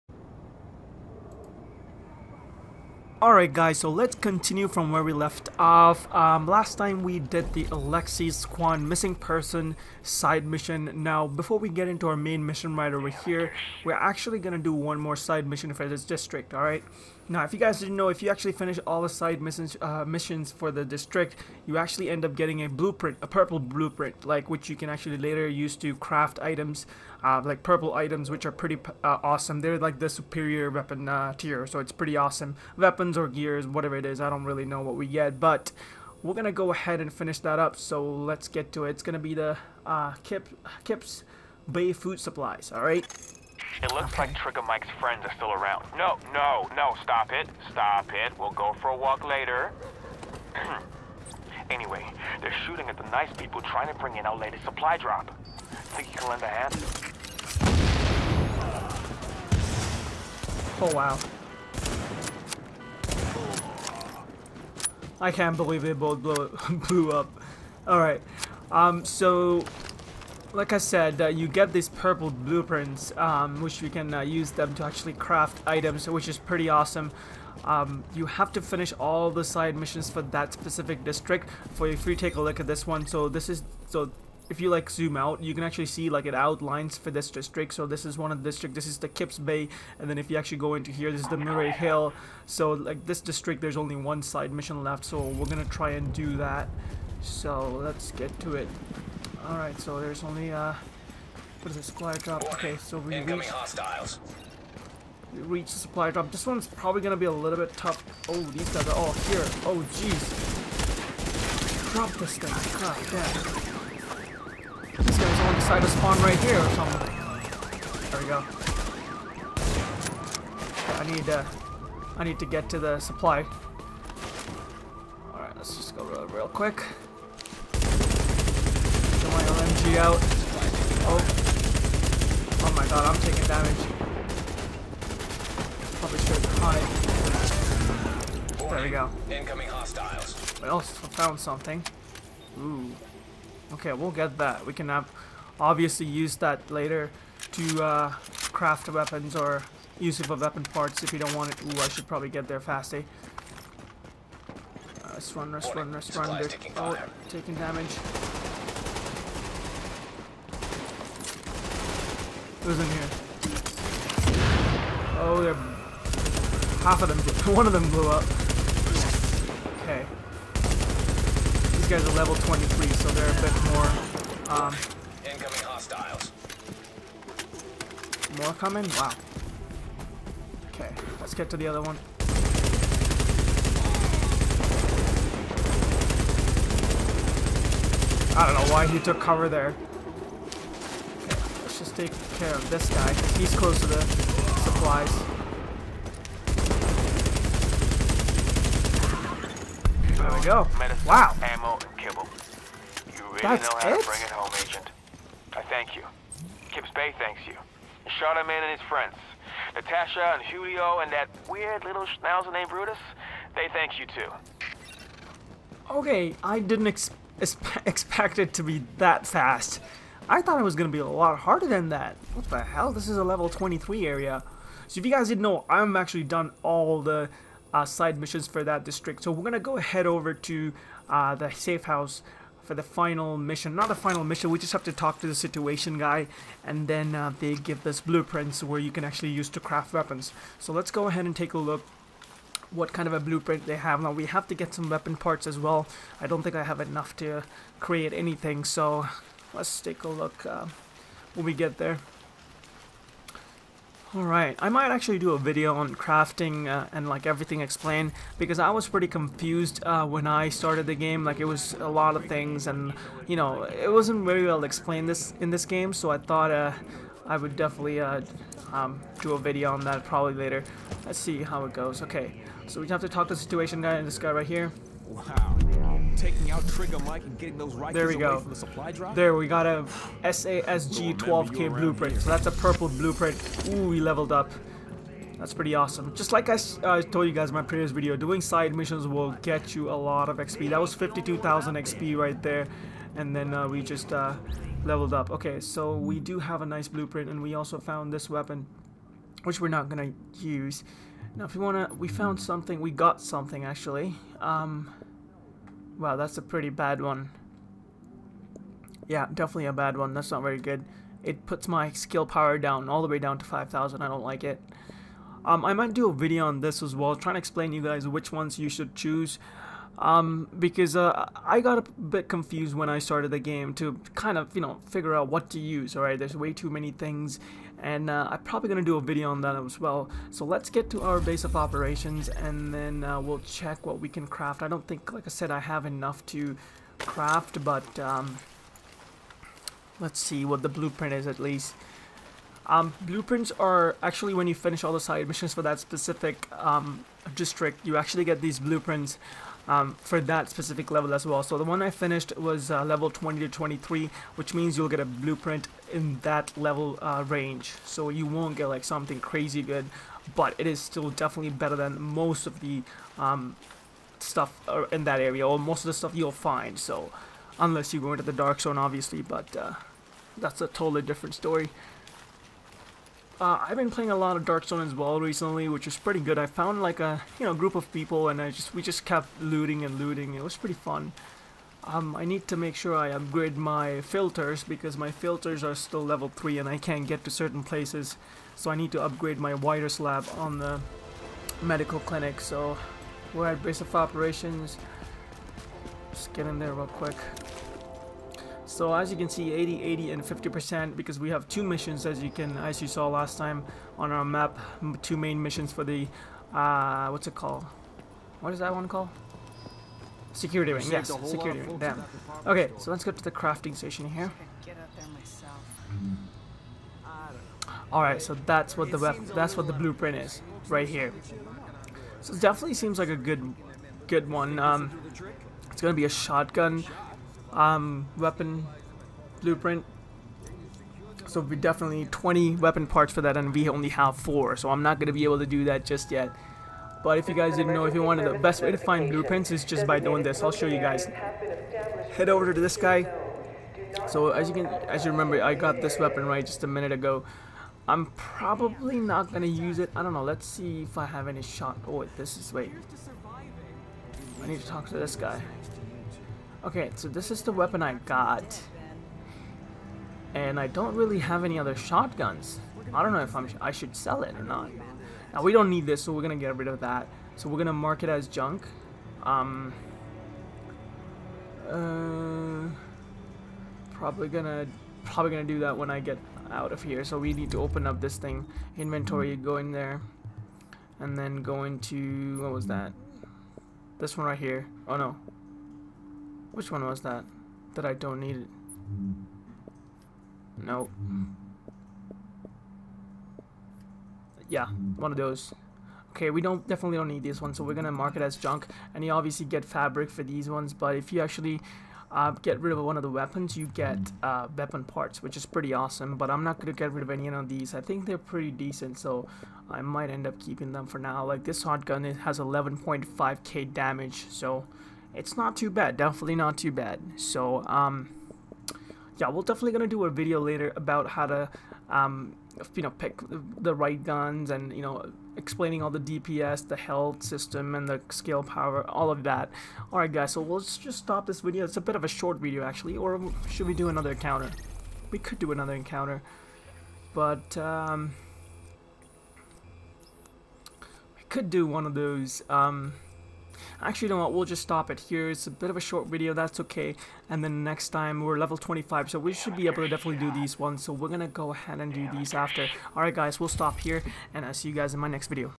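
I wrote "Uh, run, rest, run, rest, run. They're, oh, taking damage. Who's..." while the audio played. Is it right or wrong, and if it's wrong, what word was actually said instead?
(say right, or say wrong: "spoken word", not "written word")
right.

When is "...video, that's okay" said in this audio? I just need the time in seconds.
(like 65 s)
546 s.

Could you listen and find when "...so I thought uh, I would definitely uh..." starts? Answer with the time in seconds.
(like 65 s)
265 s.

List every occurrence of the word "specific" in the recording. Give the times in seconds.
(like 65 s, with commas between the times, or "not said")
80 s, 345 s, 350 s.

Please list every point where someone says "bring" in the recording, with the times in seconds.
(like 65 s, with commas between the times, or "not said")
53 s, 204 s.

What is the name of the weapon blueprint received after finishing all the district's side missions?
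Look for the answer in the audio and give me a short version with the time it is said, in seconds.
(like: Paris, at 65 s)
SASG 12K, at 280 s.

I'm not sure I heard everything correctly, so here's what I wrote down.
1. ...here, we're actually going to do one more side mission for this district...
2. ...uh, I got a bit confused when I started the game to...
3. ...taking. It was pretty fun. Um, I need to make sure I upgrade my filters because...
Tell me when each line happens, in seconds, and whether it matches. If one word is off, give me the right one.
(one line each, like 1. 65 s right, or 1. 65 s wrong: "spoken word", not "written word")
1. 13 s right
2. 320 s right
3. 379 s wrong: "looting", not "taking".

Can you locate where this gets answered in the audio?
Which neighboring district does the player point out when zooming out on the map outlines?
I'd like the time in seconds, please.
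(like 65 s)
91 s.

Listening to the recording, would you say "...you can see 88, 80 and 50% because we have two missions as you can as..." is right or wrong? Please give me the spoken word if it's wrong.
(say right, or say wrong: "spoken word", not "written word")
wrong: "80", not "88".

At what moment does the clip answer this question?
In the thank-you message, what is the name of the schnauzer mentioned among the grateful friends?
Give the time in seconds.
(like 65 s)
212 s.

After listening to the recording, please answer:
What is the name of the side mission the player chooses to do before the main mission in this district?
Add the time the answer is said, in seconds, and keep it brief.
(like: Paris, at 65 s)
Kips Bay Food Supplies, at 40 s.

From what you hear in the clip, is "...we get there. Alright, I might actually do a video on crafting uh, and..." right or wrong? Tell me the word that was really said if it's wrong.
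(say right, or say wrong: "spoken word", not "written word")
right.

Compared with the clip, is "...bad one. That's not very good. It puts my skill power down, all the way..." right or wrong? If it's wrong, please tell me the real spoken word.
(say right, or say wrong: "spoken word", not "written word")
right.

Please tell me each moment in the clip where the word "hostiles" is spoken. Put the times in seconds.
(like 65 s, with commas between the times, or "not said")
103 s, 139 s, 175 s.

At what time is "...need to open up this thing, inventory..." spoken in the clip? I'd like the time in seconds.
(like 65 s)
477 s.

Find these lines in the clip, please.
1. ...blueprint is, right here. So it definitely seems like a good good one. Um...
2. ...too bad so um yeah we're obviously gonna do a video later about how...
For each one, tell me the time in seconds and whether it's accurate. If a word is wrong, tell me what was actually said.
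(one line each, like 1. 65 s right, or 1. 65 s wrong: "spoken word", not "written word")
1. 419 s right
2. 516 s wrong: "definitely", not "obviously".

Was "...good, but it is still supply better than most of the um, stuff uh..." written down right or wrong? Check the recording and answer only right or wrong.
wrong.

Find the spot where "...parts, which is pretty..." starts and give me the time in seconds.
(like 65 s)
504 s.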